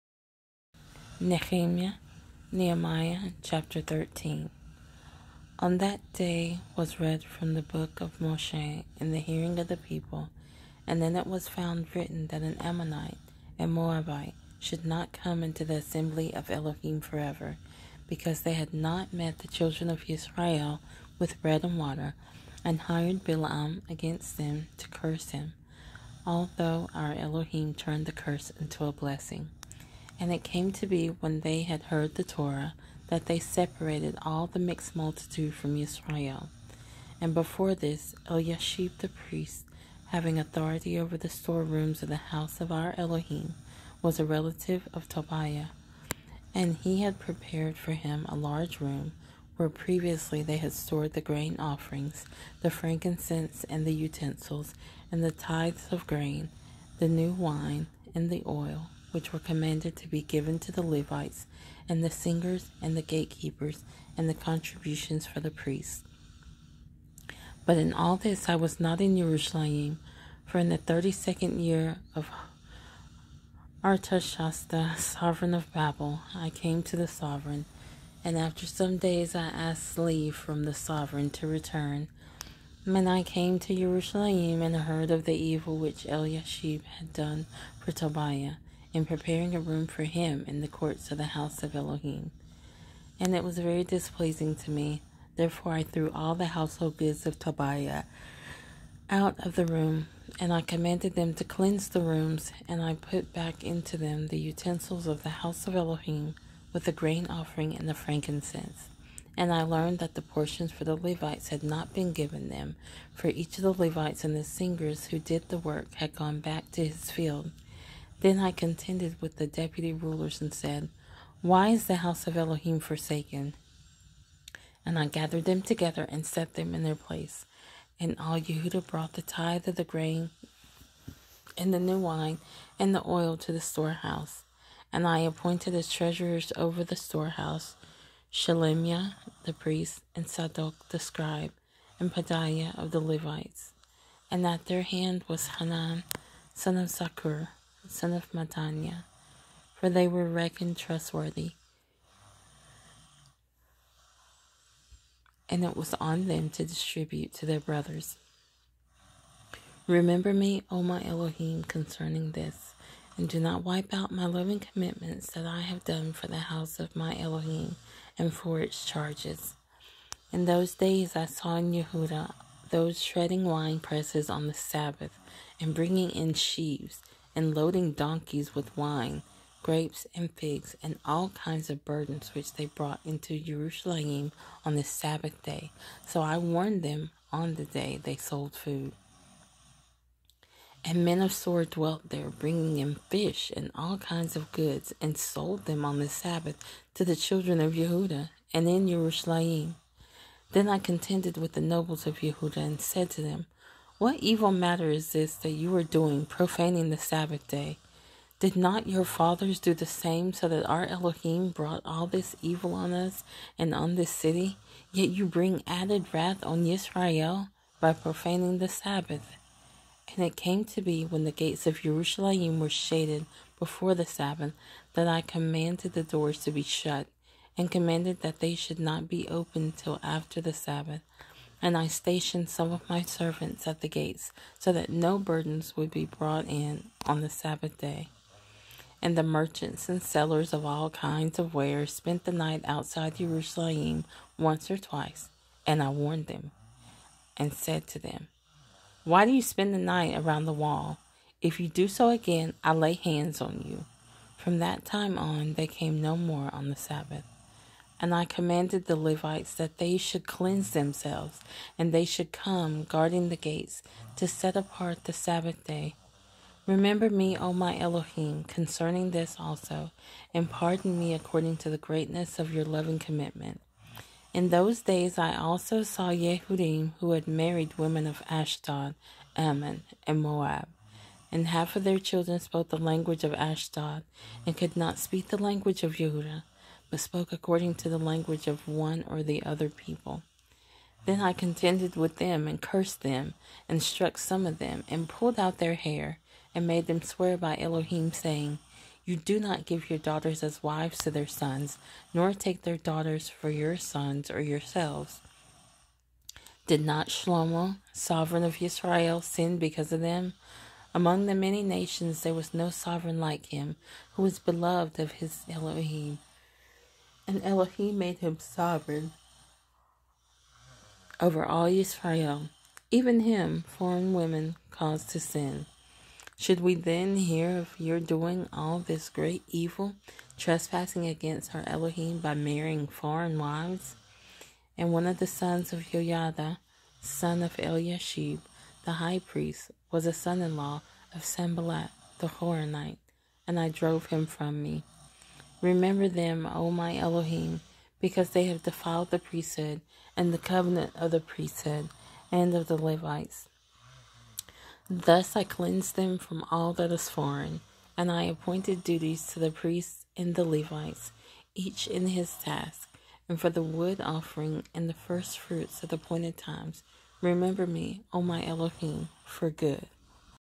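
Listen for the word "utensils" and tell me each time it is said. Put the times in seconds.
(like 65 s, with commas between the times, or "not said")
53 s, 104 s.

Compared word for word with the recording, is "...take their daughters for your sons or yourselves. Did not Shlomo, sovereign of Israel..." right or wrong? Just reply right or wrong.
right.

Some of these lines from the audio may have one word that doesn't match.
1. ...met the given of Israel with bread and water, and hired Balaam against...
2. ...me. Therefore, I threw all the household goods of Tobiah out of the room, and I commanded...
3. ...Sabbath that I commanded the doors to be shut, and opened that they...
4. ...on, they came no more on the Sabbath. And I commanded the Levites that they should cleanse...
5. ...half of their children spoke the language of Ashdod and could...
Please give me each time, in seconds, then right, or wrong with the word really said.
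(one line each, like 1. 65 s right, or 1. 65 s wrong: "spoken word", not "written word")
1. 19 s wrong: "children", not "given"
2. 94 s right
3. 224 s wrong: "commanded", not "opened"
4. 255 s right
5. 281 s right.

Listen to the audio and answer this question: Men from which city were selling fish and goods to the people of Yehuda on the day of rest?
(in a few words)
Tsor.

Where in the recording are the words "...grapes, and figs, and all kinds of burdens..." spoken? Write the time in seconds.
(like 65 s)
179 s.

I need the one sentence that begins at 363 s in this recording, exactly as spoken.
And for the wood offering and the first fruits at appointed times, remember me, O my Elohim, for good.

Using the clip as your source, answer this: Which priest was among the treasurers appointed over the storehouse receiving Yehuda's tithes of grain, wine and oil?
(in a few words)
Shalemiah.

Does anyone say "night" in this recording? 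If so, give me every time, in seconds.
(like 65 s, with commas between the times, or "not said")
242 s, 249 s.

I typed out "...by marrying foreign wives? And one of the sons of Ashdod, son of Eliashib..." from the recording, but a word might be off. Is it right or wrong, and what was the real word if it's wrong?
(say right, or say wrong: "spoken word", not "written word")
wrong: "Yoiada", not "Ashdod".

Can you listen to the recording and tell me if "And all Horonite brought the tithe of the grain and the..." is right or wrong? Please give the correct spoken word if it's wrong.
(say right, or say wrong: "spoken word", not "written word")
wrong: "Yehuda", not "Horonite".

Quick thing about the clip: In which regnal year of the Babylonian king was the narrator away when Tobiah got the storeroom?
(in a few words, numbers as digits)
32.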